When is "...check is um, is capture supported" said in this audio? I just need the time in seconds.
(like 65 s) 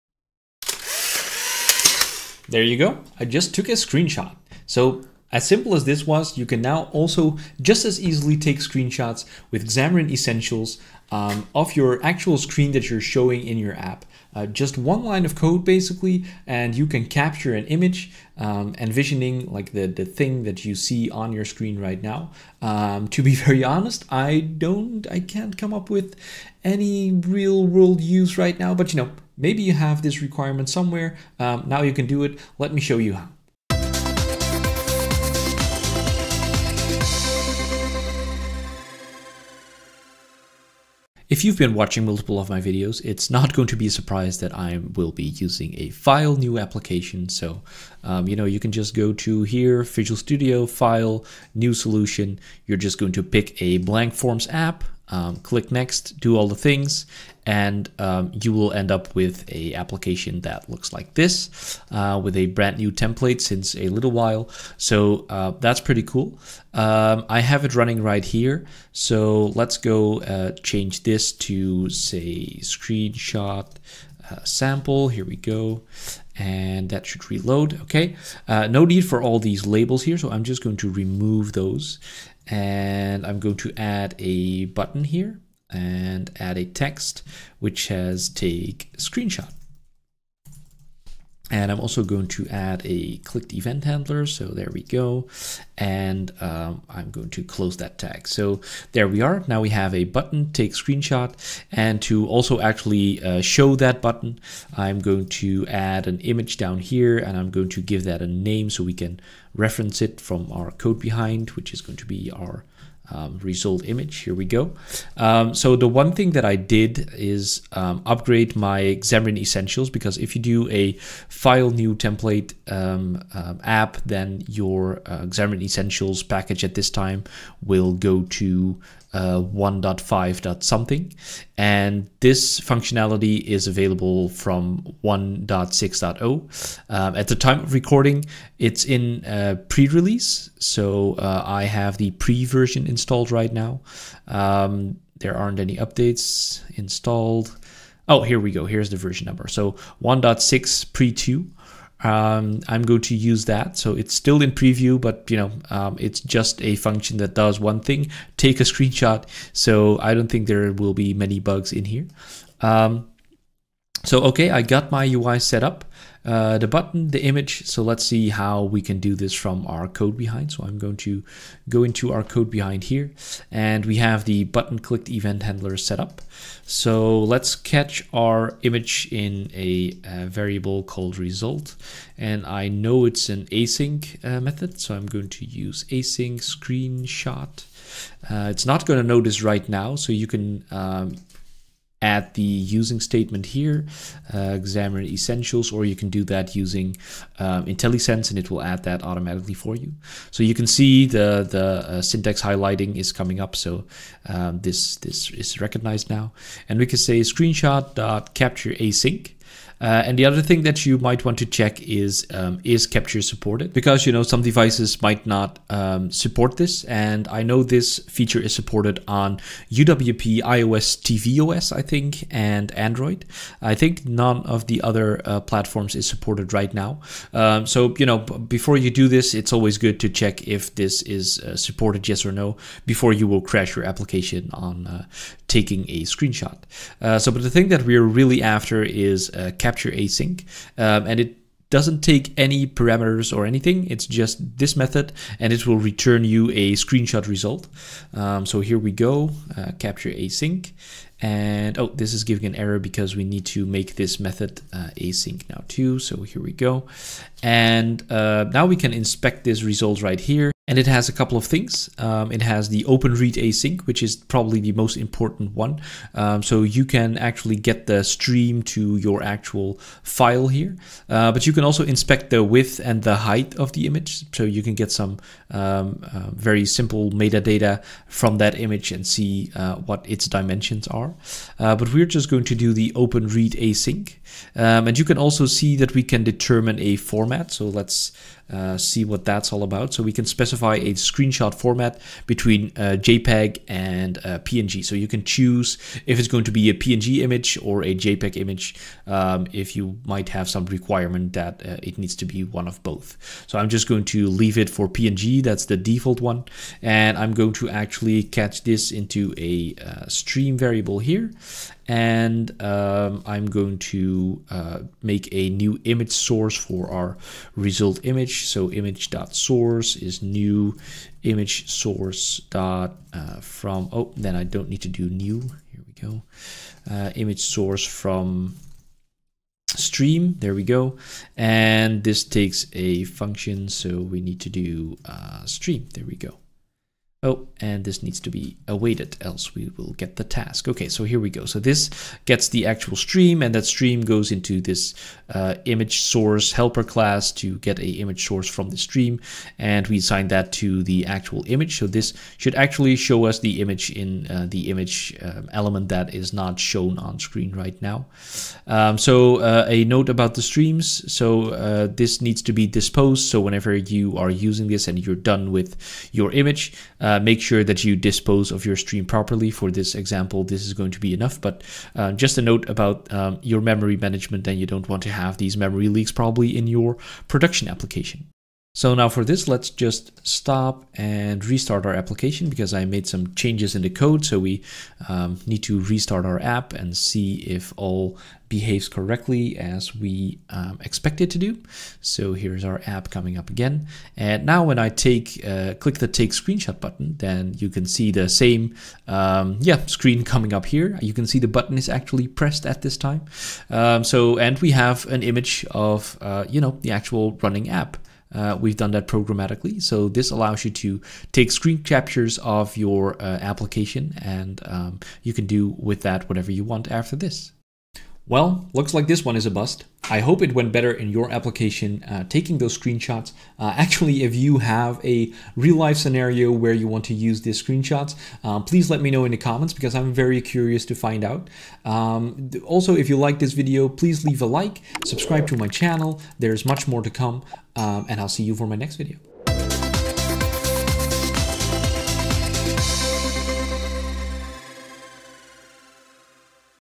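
211 s.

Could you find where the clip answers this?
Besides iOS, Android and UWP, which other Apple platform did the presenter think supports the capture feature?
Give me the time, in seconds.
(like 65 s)
221 s.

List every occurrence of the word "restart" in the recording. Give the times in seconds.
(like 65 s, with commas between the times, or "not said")
381 s, 385 s.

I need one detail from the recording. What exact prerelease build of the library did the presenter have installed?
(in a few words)
1.6 pre 2.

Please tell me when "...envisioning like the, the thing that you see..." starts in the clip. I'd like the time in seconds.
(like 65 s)
18 s.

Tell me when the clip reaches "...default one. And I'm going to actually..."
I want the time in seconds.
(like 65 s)
305 s.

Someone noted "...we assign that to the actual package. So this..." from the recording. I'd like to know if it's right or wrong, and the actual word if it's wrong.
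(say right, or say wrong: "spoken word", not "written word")
wrong: "image", not "package".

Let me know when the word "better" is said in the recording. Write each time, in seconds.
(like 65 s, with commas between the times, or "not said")
420 s.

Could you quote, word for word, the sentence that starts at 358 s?
Um, so uh, a note about the streams.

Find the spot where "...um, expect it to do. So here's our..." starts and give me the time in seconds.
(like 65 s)
390 s.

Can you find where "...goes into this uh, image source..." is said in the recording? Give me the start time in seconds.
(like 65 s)
344 s.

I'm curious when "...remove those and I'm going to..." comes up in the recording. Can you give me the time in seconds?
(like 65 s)
80 s.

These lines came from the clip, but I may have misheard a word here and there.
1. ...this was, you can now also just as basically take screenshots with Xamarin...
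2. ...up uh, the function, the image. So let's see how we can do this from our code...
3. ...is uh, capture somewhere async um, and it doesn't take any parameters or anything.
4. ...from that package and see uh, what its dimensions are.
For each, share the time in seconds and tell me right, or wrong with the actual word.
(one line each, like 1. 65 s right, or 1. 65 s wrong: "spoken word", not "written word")
1. 5 s wrong: "easily", not "basically"
2. 165 s wrong: "button", not "function"
3. 238 s wrong: "capture", not "somewhere"
4. 278 s wrong: "image", not "package".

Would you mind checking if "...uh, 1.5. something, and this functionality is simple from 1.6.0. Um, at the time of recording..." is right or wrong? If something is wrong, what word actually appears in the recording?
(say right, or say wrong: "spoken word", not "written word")
wrong: "available", not "simple".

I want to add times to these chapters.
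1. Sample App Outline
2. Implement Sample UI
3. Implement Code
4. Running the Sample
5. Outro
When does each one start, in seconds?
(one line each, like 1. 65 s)
1. 40 s
2. 69 s
3. 167 s
4. 378 s
5. 417 s.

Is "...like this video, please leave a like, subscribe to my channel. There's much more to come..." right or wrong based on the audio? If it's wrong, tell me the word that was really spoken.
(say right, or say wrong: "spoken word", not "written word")
right.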